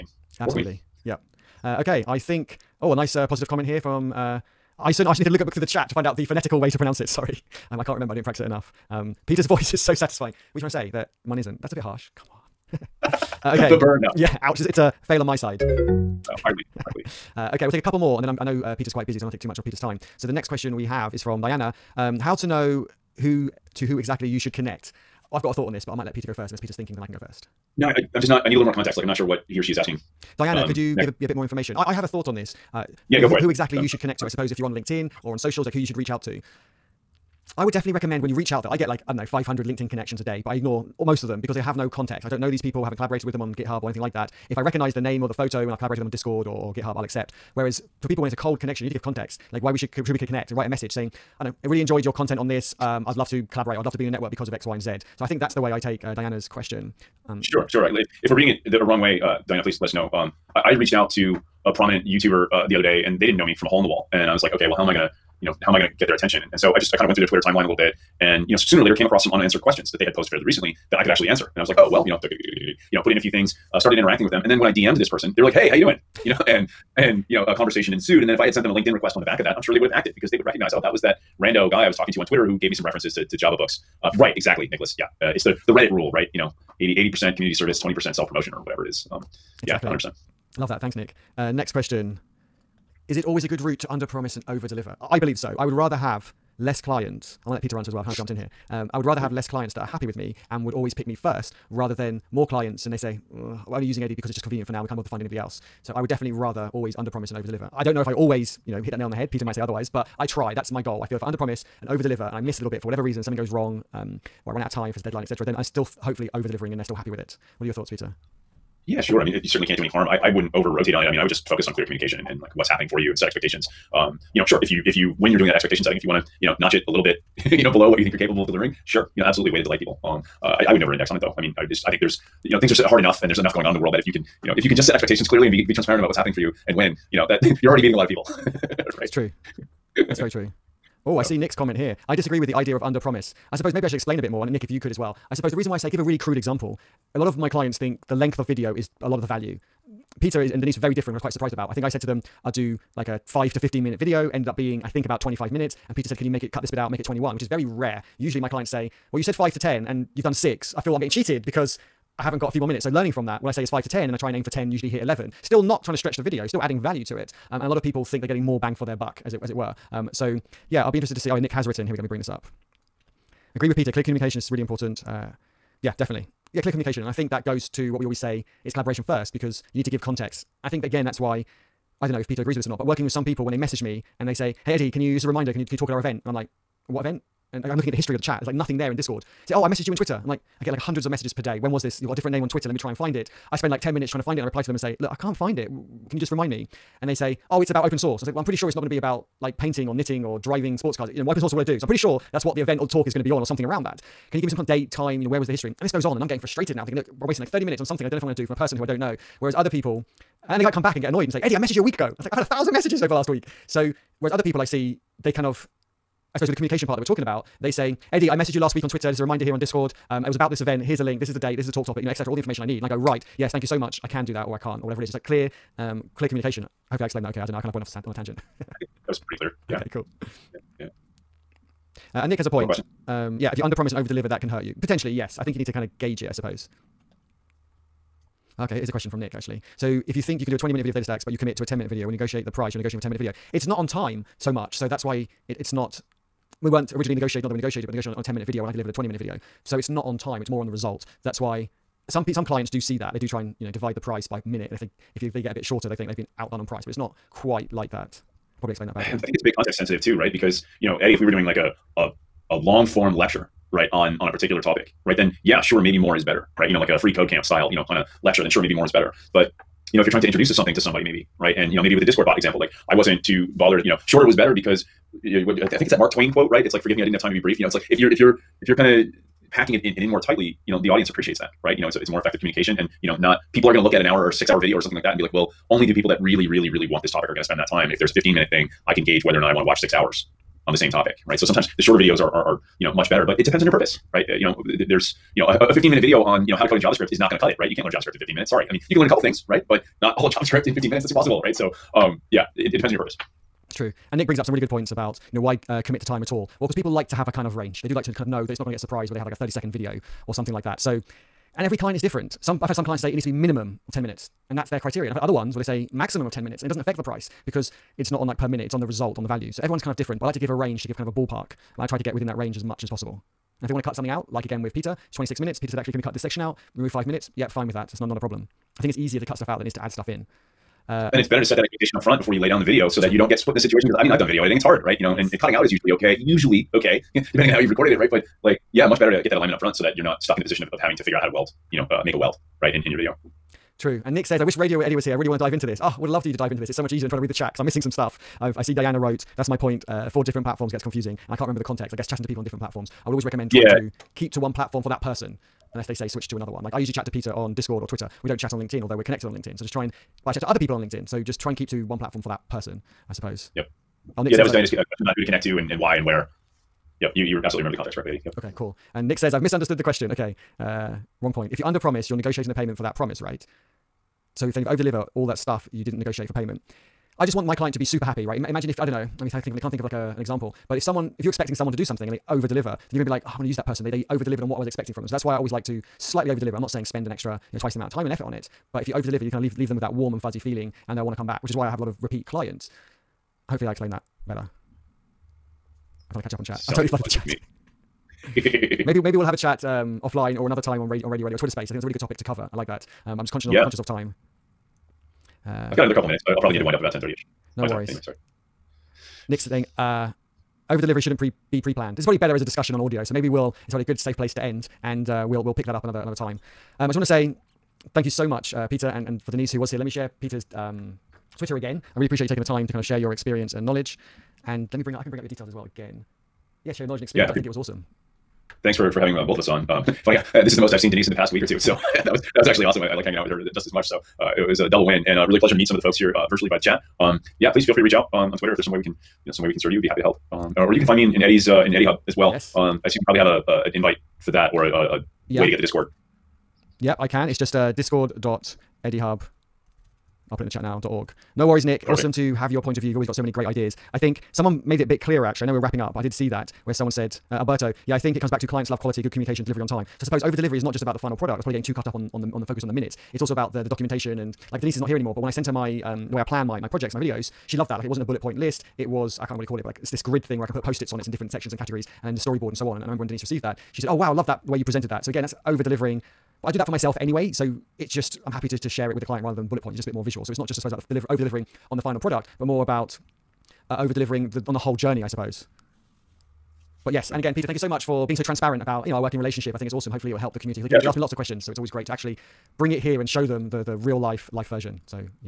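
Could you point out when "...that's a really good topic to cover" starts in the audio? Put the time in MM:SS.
06:41.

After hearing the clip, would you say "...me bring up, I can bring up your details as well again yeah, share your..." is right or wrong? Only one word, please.
right.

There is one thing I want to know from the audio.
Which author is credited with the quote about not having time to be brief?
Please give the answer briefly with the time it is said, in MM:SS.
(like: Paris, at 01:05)
Mark Twain, at 04:35.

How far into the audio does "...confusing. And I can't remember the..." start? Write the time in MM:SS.
05:50.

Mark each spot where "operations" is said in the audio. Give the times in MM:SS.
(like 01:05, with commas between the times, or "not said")
not said.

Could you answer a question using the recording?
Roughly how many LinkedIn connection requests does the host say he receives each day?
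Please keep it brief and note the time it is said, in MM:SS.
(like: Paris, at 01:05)
500, at 00:39.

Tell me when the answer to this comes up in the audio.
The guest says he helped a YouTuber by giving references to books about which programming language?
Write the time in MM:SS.
01:23.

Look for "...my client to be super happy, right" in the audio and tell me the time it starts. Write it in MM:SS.
06:17.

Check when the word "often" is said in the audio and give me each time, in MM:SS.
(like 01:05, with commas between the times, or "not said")
not said.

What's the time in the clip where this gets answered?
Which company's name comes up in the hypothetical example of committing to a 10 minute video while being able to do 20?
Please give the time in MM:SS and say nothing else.
04:00.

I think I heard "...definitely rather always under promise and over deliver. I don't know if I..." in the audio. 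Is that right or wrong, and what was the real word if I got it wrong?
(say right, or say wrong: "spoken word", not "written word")
right.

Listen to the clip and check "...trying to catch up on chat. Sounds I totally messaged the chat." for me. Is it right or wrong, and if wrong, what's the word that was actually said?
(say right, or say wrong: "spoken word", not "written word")
wrong: "flooded", not "messaged".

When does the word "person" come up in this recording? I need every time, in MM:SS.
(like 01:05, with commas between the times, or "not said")
01:15, 03:28, 05:55, 06:02, 06:23.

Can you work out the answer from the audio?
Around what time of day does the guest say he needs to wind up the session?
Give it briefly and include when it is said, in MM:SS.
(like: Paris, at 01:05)
10:30, at 06:46.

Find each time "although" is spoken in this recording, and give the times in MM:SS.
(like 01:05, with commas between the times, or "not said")
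05:58.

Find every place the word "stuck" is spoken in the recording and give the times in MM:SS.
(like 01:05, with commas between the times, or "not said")
05:40.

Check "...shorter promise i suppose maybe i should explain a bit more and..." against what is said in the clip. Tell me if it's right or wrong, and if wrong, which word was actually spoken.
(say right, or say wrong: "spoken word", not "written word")
wrong: "under", not "shorter".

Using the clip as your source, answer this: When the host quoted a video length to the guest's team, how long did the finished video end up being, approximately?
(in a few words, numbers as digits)
25 minutes.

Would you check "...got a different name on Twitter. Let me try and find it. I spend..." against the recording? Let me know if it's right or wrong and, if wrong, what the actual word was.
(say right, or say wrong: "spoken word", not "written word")
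right.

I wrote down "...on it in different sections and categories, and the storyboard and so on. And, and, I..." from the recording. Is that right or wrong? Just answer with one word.
right.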